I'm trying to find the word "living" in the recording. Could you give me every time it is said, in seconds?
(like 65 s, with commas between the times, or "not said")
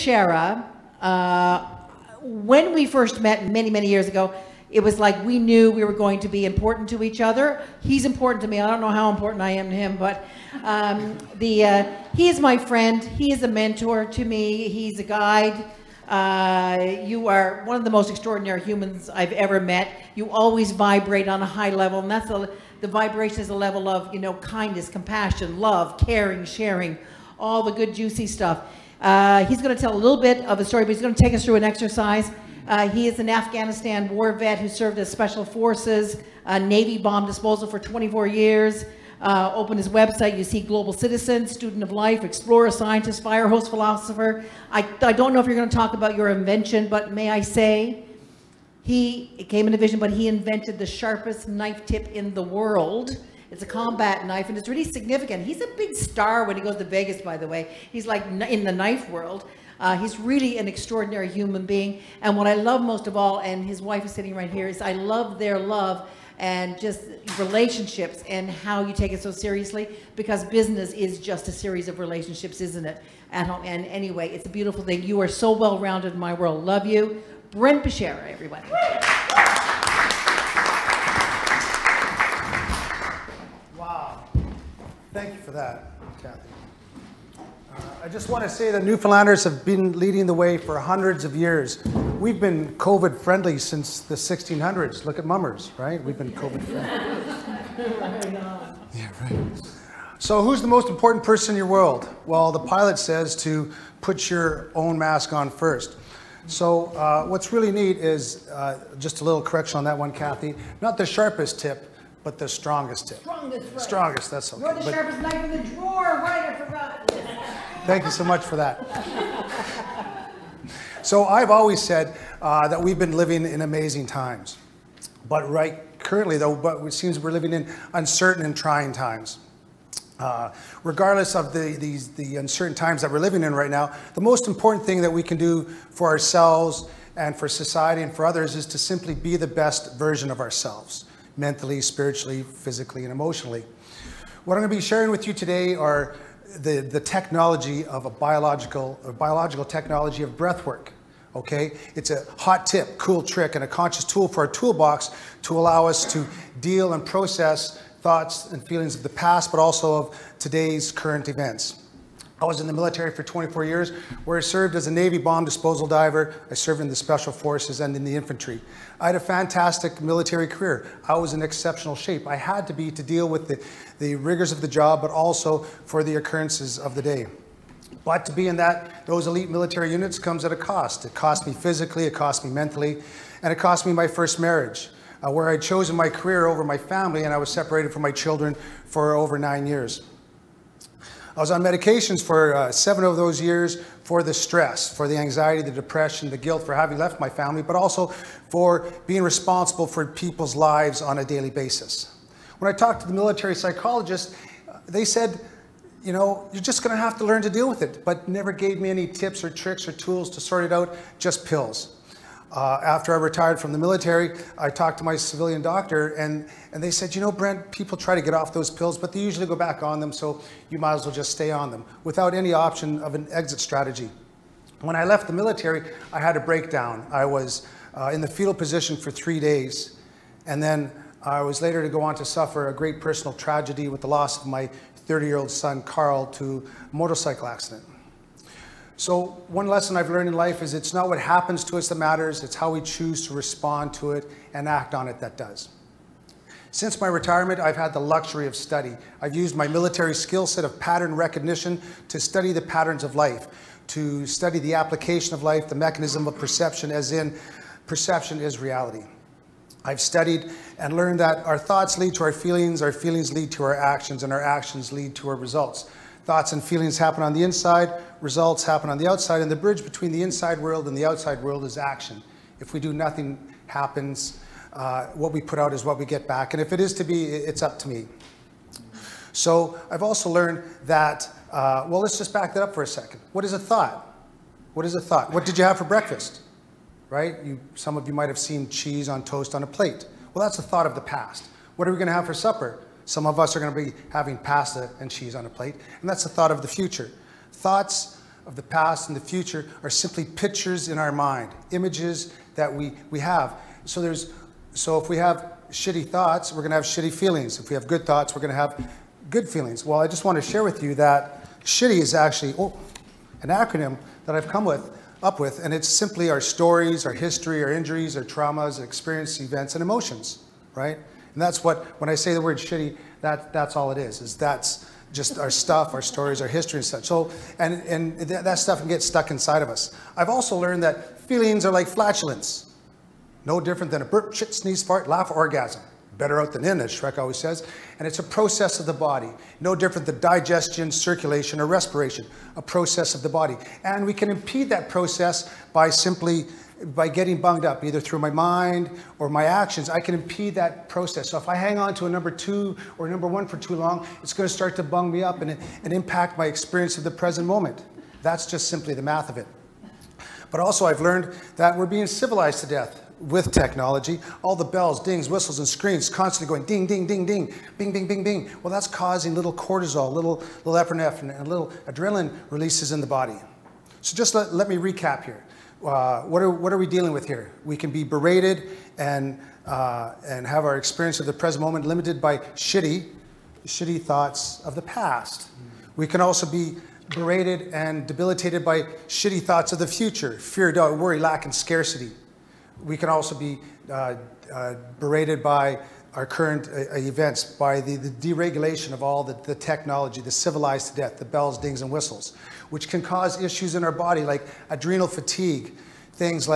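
123 s, 127 s, 133 s.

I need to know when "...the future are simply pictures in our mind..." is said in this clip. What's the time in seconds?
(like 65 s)
299 s.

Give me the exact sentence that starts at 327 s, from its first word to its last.
So, and, and th that stuff can get stuck inside of us.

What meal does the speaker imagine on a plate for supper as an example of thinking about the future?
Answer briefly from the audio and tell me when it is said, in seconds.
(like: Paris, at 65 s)
Pasta and cheese, at 294 s.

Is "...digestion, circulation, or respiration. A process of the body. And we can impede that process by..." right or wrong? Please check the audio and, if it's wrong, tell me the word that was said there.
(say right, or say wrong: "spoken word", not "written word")
right.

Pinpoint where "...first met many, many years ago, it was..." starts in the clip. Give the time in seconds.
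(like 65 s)
2 s.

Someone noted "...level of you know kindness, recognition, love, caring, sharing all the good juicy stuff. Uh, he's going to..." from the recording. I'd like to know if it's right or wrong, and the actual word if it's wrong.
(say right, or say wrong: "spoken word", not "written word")
wrong: "compassion", not "recognition".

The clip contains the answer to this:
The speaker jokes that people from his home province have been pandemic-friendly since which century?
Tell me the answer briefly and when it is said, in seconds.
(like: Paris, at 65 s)
1600s, at 94 s.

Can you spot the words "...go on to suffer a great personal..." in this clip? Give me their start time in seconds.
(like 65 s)
231 s.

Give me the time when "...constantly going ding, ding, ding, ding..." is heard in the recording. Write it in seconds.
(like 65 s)
366 s.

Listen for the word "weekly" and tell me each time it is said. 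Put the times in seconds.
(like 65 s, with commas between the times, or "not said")
not said.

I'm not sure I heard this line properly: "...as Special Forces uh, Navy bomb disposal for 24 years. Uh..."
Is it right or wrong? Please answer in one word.
right.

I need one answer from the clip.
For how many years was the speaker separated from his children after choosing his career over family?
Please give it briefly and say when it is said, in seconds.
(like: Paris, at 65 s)
9, at 189 s.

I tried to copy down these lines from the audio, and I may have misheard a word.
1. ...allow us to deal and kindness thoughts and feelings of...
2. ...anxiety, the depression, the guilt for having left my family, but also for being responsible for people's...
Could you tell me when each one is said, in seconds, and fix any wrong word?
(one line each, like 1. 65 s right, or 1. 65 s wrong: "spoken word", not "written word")
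1. 155 s wrong: "process", not "kindness"
2. 195 s right.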